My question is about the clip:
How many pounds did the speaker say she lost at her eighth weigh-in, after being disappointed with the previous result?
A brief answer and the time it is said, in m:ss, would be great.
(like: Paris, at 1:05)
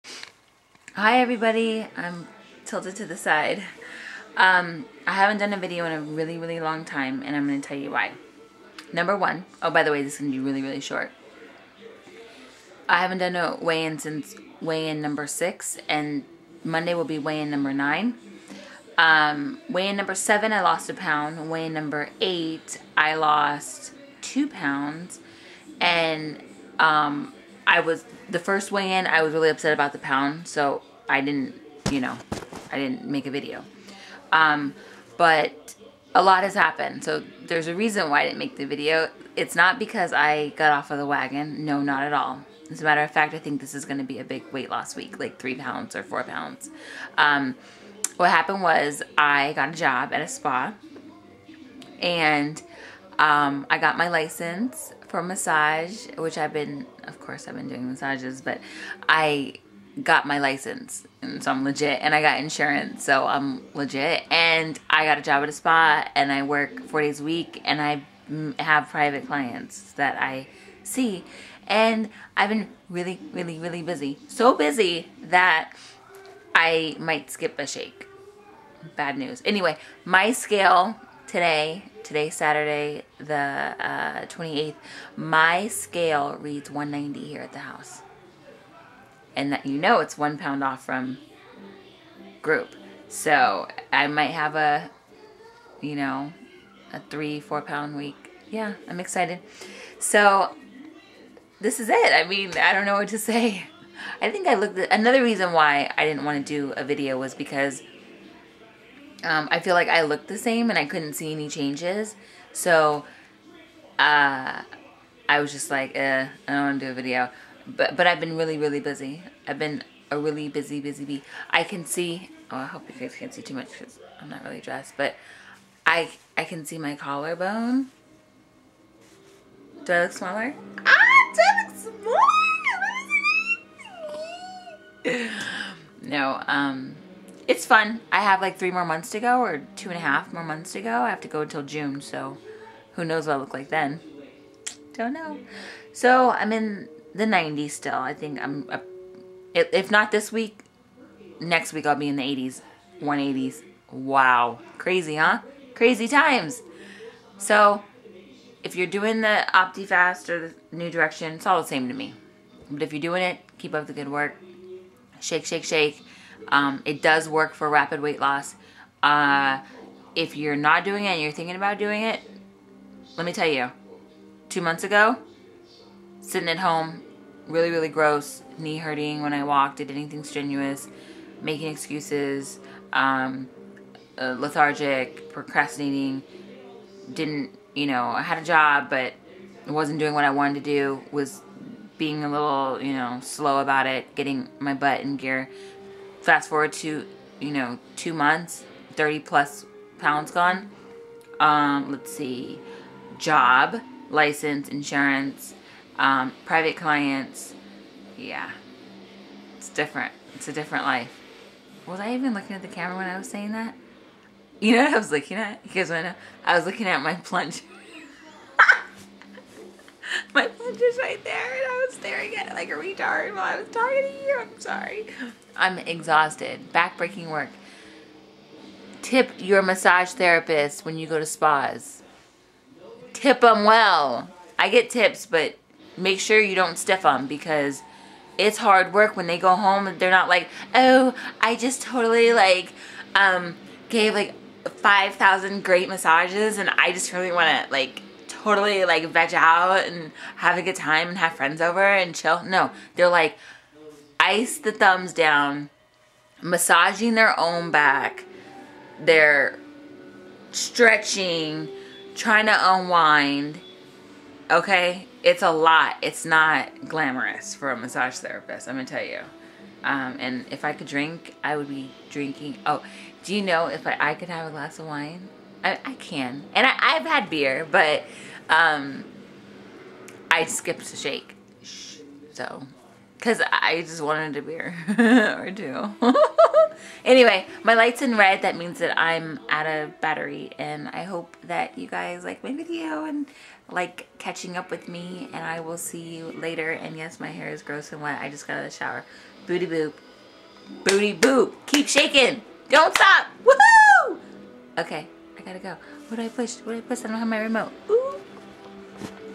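2 pounds, at 0:24.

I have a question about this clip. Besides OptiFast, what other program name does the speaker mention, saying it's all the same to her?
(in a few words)
New Direction.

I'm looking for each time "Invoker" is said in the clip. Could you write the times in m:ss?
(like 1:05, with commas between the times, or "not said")
not said.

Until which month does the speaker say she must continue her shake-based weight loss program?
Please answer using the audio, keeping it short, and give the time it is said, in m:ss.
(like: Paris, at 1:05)
June, at 2:21.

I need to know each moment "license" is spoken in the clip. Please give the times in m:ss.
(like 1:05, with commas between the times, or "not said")
0:54, 1:00, 3:24.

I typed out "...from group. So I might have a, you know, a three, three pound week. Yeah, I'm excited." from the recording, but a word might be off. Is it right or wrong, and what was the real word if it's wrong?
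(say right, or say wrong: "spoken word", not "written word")
wrong: "four", not "three".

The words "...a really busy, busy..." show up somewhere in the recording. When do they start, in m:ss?
2:00.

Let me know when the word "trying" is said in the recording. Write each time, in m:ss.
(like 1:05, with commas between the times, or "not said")
4:22.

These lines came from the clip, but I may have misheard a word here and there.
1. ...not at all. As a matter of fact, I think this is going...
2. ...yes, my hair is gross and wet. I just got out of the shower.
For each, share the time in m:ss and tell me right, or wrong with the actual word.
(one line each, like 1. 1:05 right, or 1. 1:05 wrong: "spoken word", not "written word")
1. 0:41 right
2. 4:56 right.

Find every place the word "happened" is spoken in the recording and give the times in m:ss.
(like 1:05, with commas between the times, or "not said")
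0:36, 0:48.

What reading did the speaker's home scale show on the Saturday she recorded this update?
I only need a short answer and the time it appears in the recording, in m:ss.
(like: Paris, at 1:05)
190, at 1:26.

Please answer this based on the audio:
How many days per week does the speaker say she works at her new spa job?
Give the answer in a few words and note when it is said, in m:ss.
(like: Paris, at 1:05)
4 days, at 1:06.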